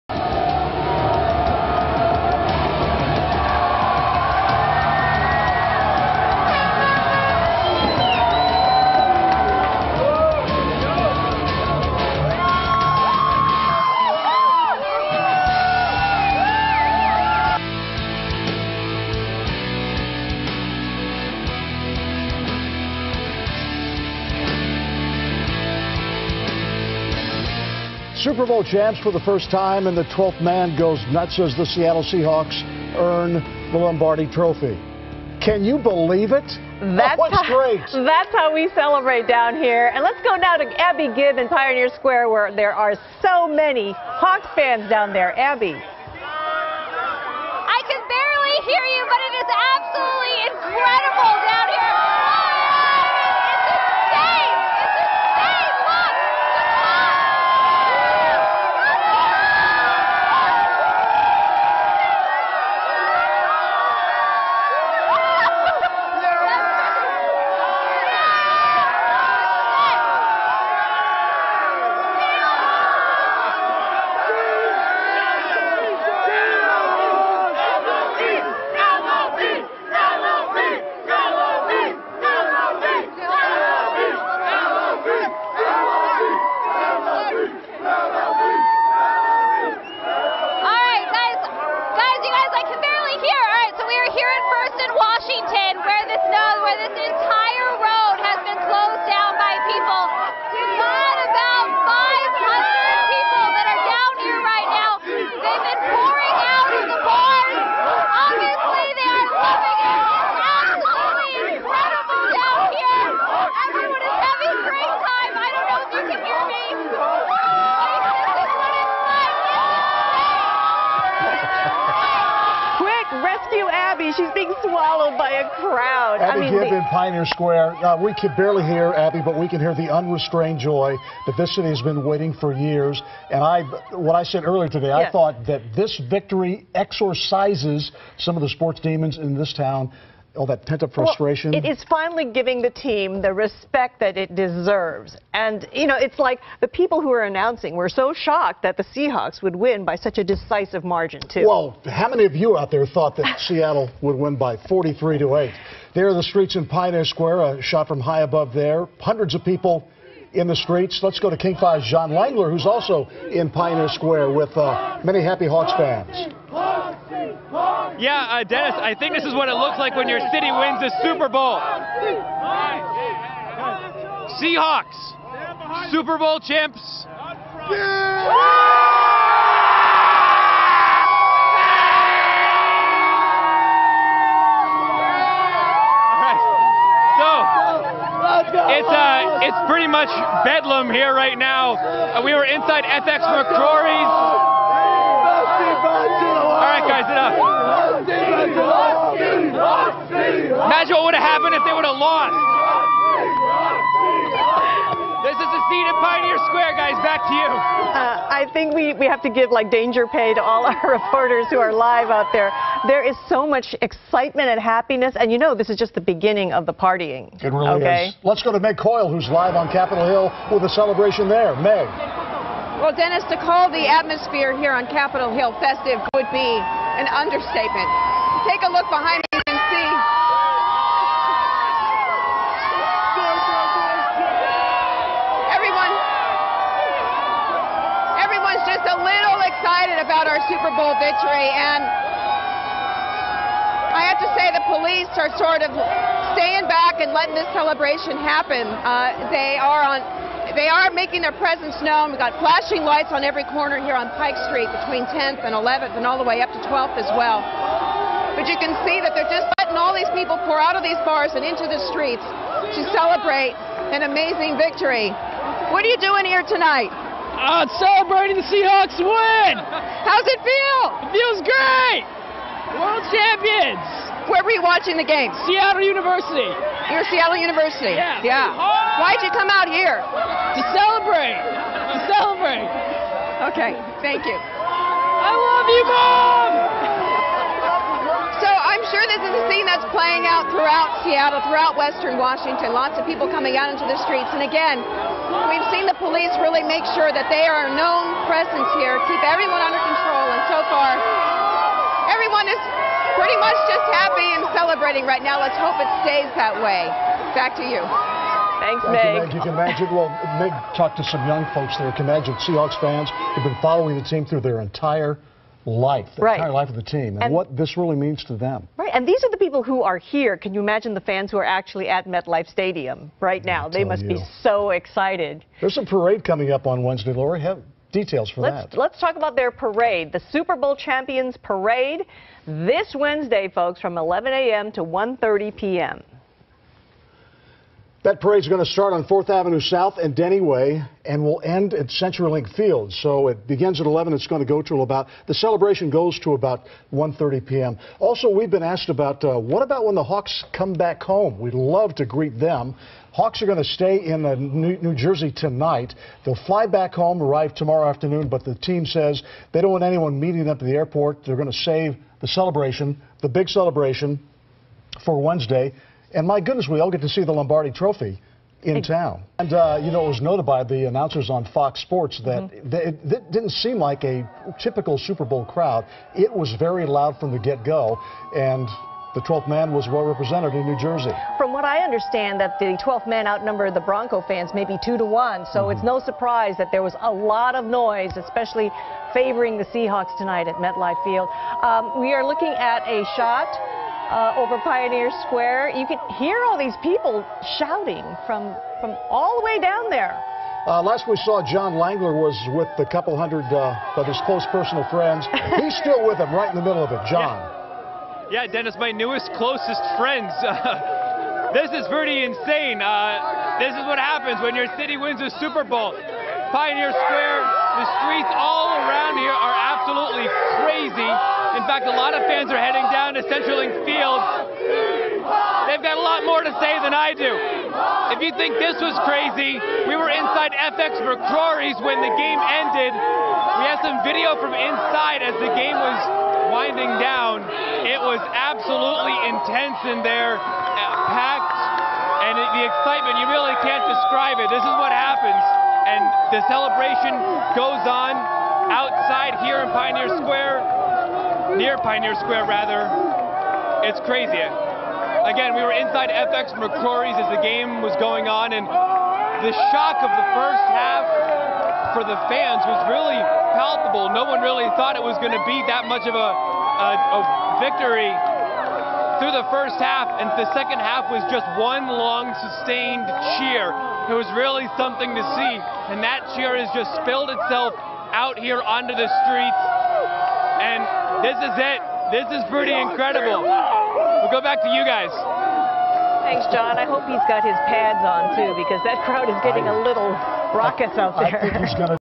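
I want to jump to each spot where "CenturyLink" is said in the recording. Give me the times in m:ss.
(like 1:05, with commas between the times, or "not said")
5:41, 7:03.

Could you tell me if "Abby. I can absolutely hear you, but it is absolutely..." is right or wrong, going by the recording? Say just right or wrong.
wrong.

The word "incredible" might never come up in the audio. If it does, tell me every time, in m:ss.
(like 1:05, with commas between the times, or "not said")
0:50, 8:02.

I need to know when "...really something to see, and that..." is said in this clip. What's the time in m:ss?
7:54.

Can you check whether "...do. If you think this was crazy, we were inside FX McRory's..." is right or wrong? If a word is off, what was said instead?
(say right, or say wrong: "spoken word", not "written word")
right.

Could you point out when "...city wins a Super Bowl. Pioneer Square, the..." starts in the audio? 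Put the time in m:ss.
6:54.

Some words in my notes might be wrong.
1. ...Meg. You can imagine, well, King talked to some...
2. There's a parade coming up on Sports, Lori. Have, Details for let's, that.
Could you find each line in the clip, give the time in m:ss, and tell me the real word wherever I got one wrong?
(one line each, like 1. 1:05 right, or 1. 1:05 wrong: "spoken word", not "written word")
1. 5:09 wrong: "Meg", not "King"
2. 5:25 wrong: "Wednesday", not "Sports".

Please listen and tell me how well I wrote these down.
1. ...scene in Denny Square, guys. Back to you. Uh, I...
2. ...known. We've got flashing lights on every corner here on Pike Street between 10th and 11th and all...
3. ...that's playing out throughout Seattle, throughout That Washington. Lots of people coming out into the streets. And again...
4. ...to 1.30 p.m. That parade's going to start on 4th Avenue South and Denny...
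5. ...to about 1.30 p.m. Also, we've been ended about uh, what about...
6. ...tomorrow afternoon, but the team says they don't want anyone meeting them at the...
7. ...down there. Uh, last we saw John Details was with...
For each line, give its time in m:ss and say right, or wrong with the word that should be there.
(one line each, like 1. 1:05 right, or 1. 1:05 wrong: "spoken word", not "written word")
1. 3:25 wrong: "Pioneer", not "Denny"
2. 4:11 right
3. 4:49 wrong: "Western", not "That"
4. 5:34 right
5. 5:46 wrong: "asked", not "ended"
6. 5:57 right
7. 6:39 wrong: "Langeler", not "Details".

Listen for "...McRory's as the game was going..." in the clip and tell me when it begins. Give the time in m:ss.
7:36.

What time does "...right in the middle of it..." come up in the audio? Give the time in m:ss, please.
6:46.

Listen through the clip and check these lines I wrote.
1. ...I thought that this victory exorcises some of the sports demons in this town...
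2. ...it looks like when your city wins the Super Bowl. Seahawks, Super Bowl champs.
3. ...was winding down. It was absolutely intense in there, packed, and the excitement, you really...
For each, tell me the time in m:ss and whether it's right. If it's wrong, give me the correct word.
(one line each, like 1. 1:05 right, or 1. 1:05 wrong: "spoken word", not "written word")
1. 2:14 right
2. 2:49 right
3. 7:15 right.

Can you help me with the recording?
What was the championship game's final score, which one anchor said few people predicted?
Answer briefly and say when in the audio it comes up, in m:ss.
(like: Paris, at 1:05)
43 to 8, at 2:34.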